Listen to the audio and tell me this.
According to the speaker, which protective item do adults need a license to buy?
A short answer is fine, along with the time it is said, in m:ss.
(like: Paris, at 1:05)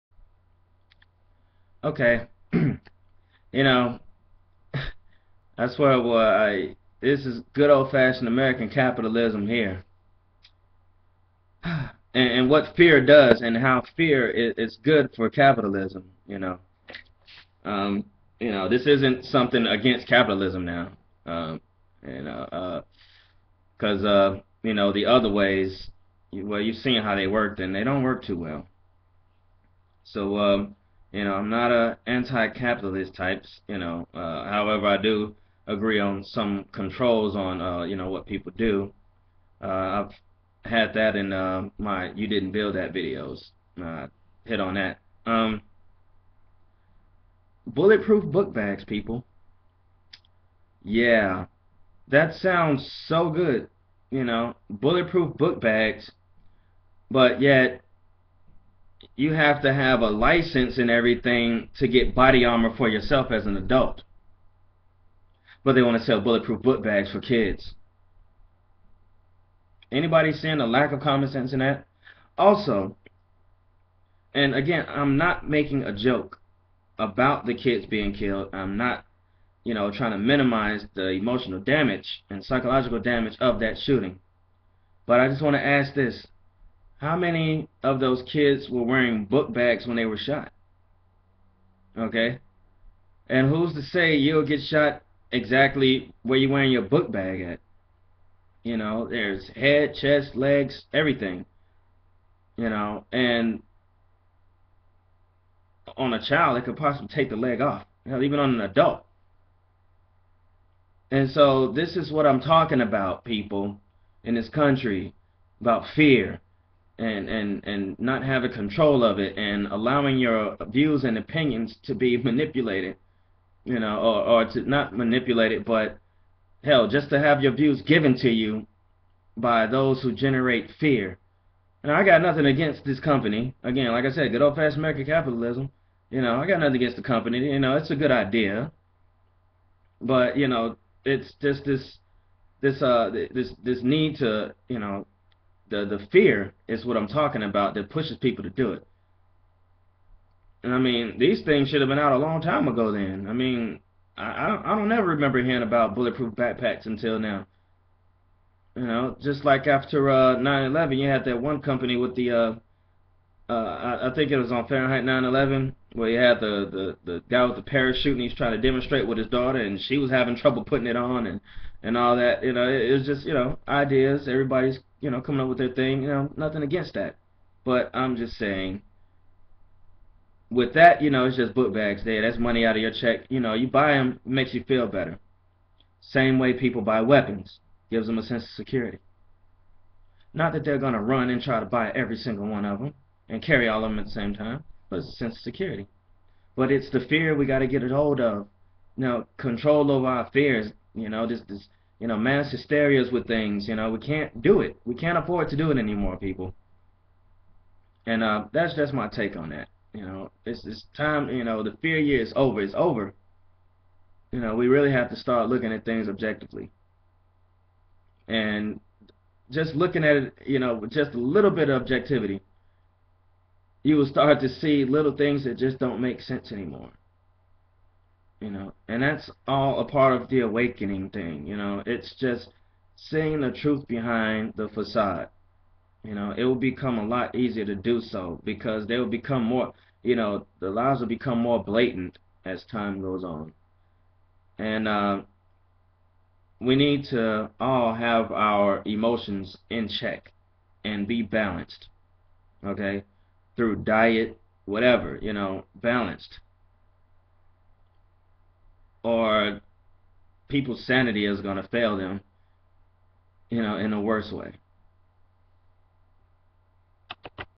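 body armor, at 1:02.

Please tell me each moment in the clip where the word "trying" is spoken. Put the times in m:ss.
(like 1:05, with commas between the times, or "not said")
1:19, 2:48.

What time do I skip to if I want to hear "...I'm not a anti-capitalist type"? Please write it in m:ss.
0:31.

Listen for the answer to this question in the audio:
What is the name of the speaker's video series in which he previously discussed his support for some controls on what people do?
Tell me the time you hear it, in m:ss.
0:42.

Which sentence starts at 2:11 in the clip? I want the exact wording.
And I got nothing against this company.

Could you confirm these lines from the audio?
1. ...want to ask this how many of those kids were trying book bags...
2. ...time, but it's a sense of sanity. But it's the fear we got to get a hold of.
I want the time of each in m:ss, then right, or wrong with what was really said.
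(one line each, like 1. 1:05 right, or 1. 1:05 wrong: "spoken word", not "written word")
1. 1:25 wrong: "wearing", not "trying"
2. 3:14 wrong: "security", not "sanity".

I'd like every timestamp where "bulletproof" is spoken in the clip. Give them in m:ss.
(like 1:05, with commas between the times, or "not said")
0:47, 0:54, 1:06, 2:35.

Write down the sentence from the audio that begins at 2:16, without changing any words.
You know, I got nothing against the company.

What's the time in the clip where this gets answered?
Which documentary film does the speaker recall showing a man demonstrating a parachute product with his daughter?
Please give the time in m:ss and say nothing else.
2:44.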